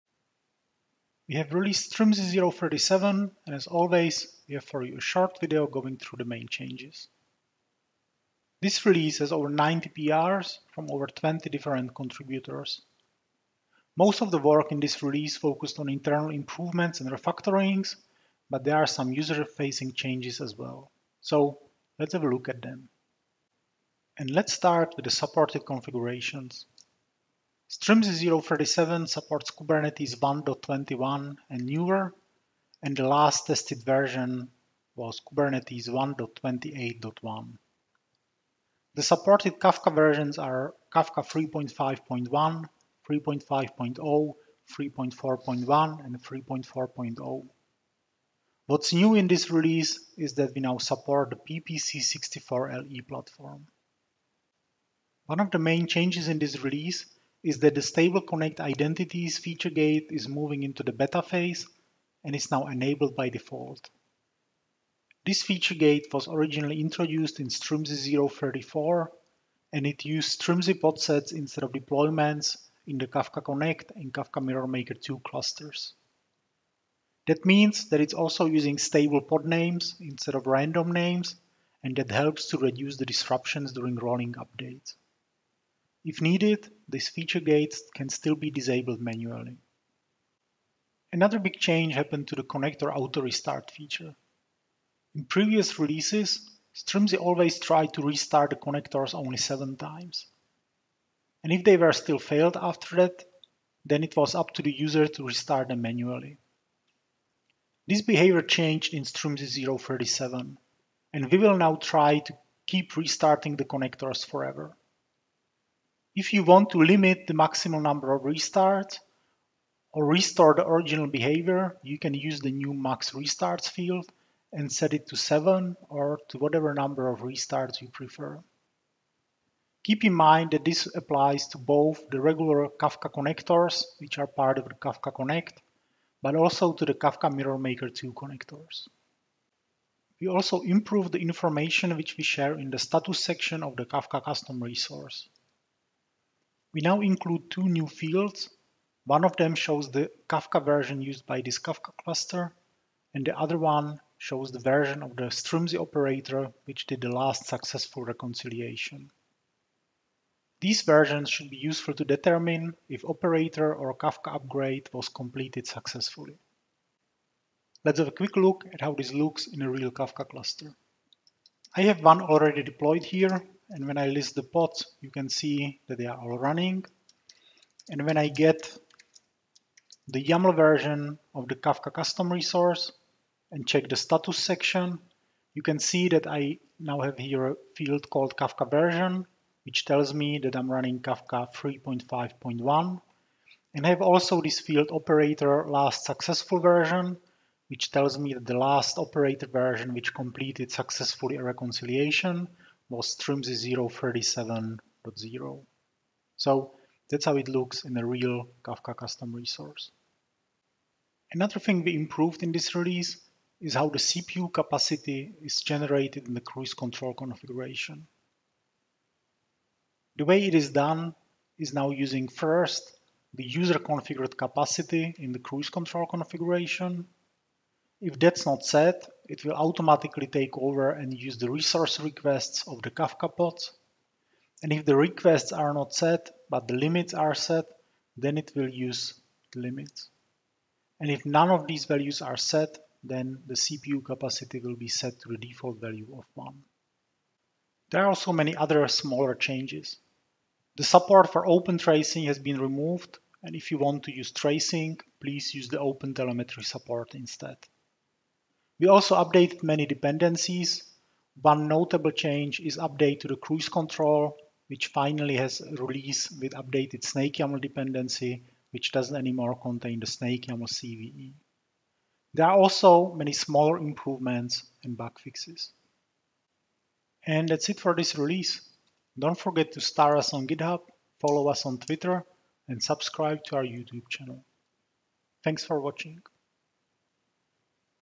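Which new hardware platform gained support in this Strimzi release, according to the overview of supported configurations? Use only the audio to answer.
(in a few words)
PPC64LE.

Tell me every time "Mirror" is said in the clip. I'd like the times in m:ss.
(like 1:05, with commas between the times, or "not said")
1:14, 2:17.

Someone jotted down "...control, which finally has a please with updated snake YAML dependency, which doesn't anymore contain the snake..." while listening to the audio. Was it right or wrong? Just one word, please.
wrong.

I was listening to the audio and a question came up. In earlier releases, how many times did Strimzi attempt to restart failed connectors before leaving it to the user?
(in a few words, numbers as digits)
7.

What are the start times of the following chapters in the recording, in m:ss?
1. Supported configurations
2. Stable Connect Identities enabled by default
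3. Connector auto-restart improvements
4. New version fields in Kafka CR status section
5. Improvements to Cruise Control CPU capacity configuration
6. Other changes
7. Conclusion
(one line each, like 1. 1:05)
1. 0:24
2. 0:54
3. 1:30
4. 2:20
5. 3:31
6. 4:07
7. 4:37.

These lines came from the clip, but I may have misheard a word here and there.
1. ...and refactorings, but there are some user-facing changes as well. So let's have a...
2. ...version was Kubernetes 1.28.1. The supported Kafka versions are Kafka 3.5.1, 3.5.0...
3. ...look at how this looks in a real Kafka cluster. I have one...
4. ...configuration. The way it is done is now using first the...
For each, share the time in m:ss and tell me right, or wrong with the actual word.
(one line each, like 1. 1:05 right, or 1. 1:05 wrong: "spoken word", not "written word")
1. 0:17 right
2. 0:33 right
3. 2:48 right
4. 3:37 right.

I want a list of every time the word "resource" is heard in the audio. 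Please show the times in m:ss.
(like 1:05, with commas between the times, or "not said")
2:24, 3:02, 3:29, 3:51.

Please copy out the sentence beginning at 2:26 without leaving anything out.
We now include two new fields.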